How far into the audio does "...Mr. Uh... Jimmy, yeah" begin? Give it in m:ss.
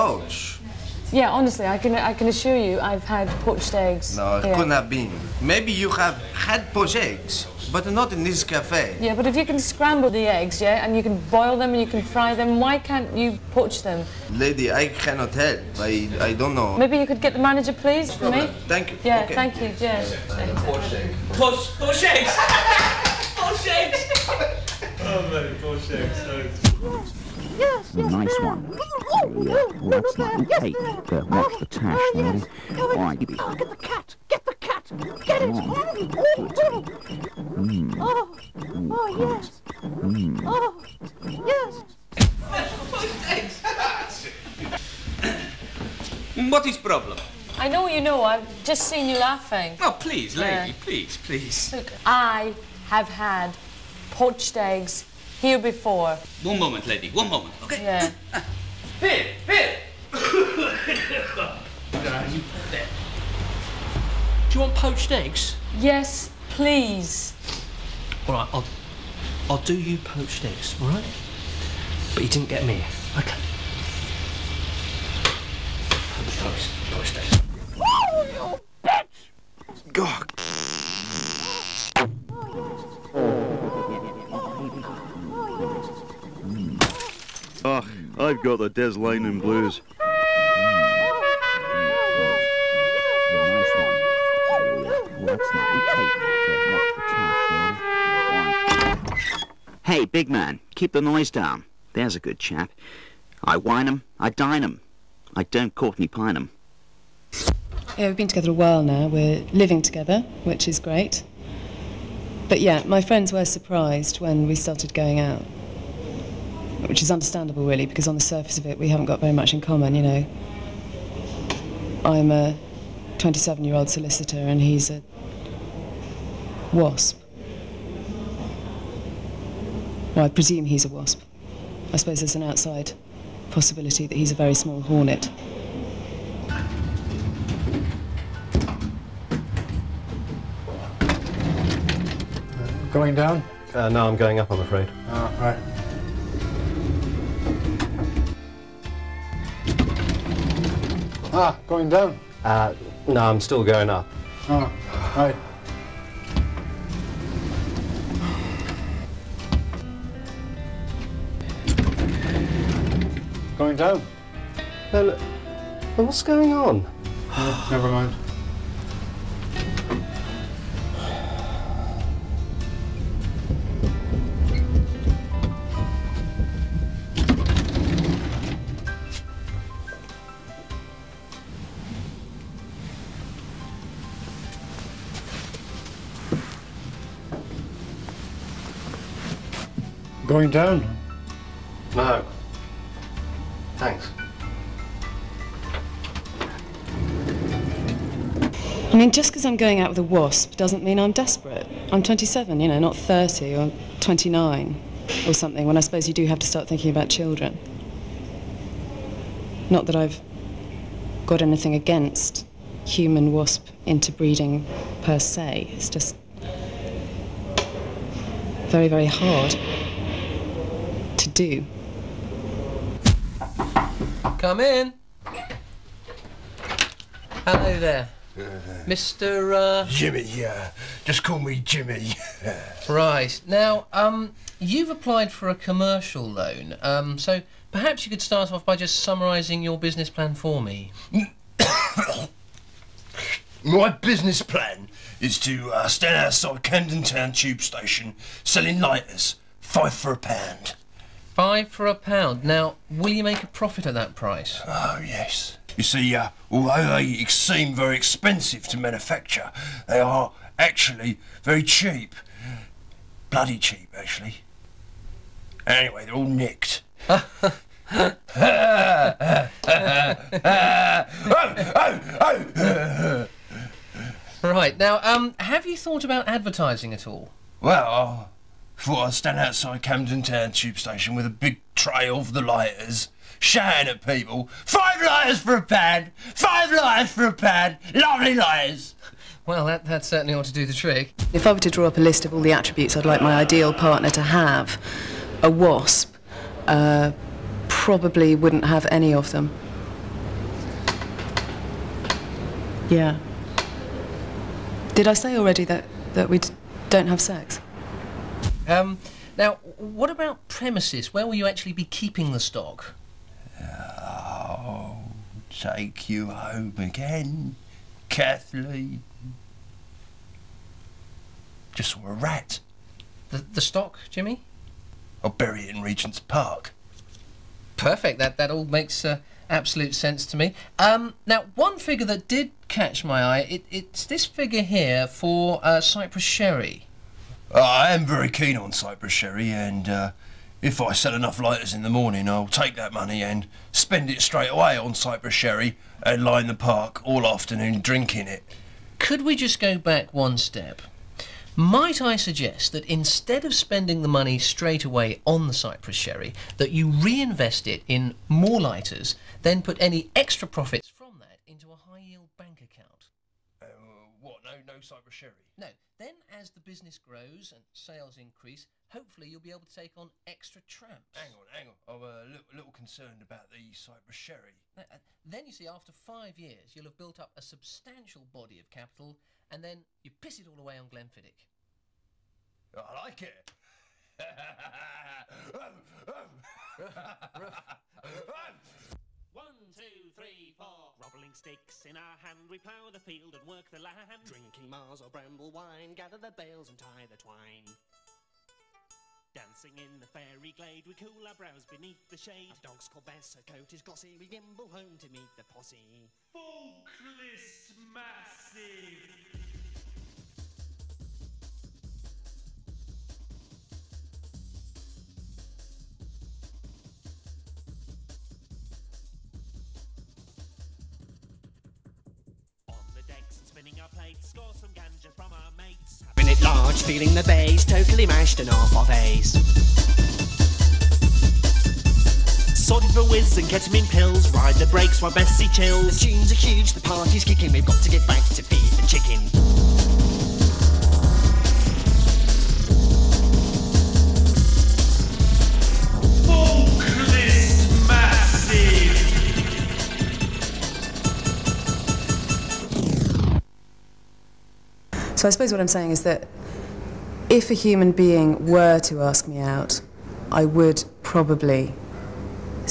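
3:48.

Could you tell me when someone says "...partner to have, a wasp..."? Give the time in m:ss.
4:53.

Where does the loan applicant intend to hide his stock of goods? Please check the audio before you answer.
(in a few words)
Regent's Park.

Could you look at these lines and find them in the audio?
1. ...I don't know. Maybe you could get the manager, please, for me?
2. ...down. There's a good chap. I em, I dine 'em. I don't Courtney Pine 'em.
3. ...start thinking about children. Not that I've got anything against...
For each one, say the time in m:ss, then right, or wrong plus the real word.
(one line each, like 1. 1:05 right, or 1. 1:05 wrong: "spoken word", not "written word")
1. 0:16 right
2. 1:41 right
3. 3:26 right.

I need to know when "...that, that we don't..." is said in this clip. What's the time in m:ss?
5:05.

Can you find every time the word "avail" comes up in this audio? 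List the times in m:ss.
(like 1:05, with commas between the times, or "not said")
not said.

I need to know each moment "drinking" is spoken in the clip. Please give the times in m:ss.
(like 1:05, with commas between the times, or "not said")
5:47, 6:34.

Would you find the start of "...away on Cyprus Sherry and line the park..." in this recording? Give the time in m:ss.
5:44.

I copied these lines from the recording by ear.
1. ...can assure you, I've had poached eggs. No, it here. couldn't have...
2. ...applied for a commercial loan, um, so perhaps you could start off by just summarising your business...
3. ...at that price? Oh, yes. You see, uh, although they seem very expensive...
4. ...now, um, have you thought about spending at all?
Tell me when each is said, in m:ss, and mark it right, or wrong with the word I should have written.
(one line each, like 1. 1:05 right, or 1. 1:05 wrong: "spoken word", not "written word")
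1. 0:02 right
2. 3:54 right
3. 4:13 right
4. 4:34 wrong: "advertising", not "spending".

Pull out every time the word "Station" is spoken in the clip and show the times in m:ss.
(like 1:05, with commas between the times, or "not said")
4:07, 4:40.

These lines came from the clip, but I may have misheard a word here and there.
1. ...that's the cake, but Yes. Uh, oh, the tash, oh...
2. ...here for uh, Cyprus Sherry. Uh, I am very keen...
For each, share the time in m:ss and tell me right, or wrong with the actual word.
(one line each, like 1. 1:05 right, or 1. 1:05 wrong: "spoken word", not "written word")
1. 0:30 right
2. 5:34 right.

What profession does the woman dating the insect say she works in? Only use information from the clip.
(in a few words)
Solicitor.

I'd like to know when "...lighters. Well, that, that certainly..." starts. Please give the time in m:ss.
4:48.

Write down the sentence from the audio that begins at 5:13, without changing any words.
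Oh, take you home again, Kathleen.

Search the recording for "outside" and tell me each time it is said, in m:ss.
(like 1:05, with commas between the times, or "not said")
2:12, 4:06, 4:39.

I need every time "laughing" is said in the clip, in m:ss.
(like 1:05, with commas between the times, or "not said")
0:49.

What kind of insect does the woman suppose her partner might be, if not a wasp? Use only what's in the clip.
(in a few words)
Hornet.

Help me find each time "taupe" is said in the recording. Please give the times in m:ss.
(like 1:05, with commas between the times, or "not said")
not said.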